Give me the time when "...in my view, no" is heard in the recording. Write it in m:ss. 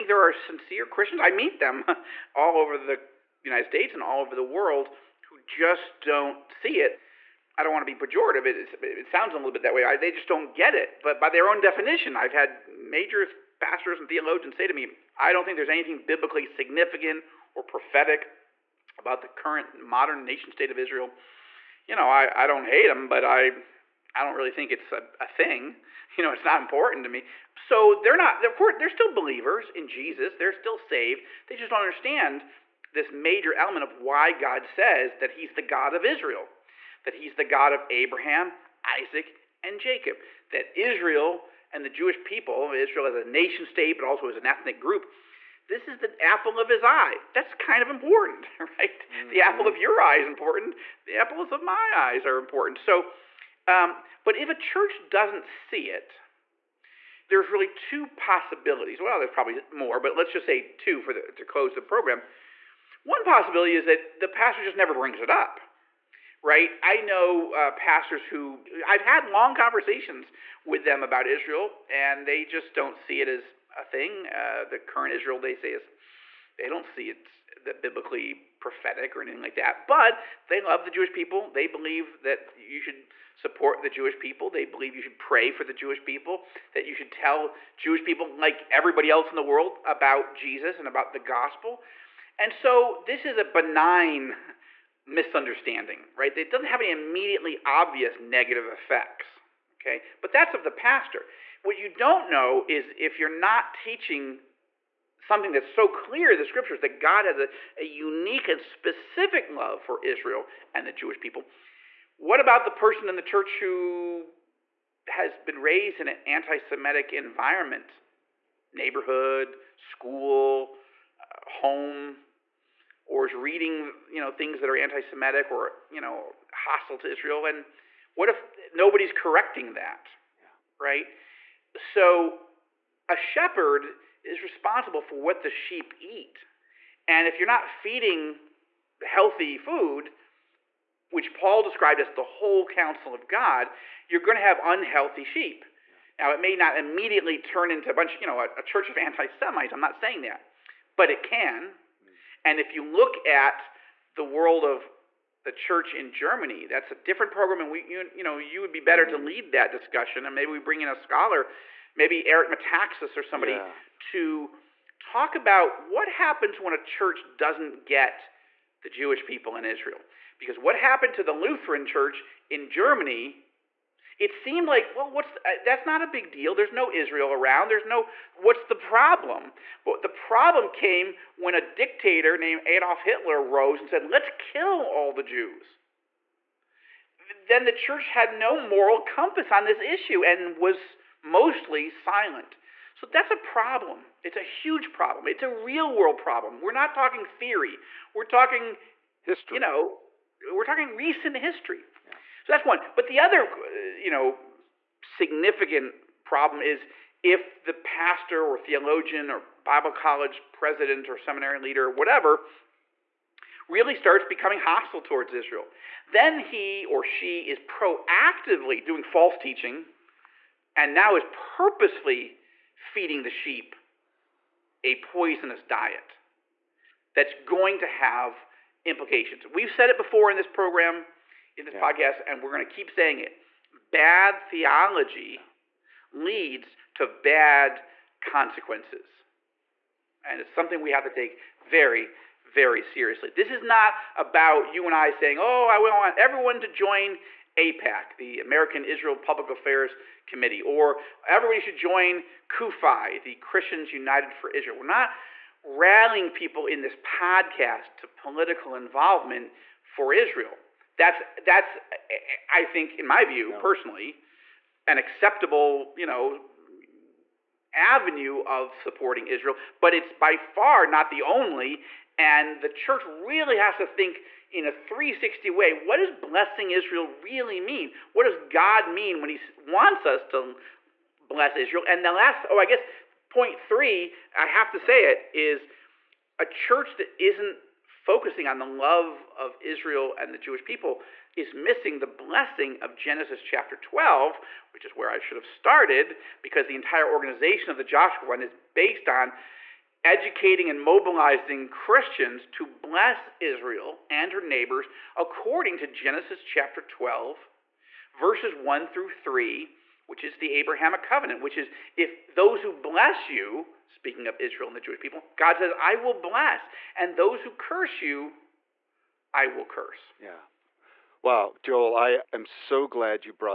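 4:22.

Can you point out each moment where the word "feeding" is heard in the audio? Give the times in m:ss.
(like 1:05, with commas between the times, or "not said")
2:17, 3:42.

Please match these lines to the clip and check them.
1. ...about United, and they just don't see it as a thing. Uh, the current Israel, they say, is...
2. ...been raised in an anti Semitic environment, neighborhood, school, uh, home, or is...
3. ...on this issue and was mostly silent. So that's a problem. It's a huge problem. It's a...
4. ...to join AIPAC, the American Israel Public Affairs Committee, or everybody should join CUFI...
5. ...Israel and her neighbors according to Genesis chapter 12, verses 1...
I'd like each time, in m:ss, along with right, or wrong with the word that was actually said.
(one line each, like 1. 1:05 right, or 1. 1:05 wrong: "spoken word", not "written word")
1. 1:11 wrong: "Israel", not "United"
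2. 1:55 right
3. 3:09 right
4. 4:06 right
5. 5:03 right.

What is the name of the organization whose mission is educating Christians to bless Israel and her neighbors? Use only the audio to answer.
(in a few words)
the Joshua Fund.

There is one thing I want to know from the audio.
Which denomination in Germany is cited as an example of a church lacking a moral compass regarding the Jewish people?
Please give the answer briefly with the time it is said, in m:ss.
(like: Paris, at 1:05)
Lutheran, at 2:51.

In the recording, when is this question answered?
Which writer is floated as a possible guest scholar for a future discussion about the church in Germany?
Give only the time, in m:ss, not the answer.
2:42.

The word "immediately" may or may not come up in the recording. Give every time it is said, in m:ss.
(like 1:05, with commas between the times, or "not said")
1:36, 2:26.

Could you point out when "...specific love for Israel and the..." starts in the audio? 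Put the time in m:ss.
1:48.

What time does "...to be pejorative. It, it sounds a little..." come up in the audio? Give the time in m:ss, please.
0:07.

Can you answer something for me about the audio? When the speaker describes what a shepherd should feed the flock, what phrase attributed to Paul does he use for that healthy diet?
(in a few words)
the whole counsel of God.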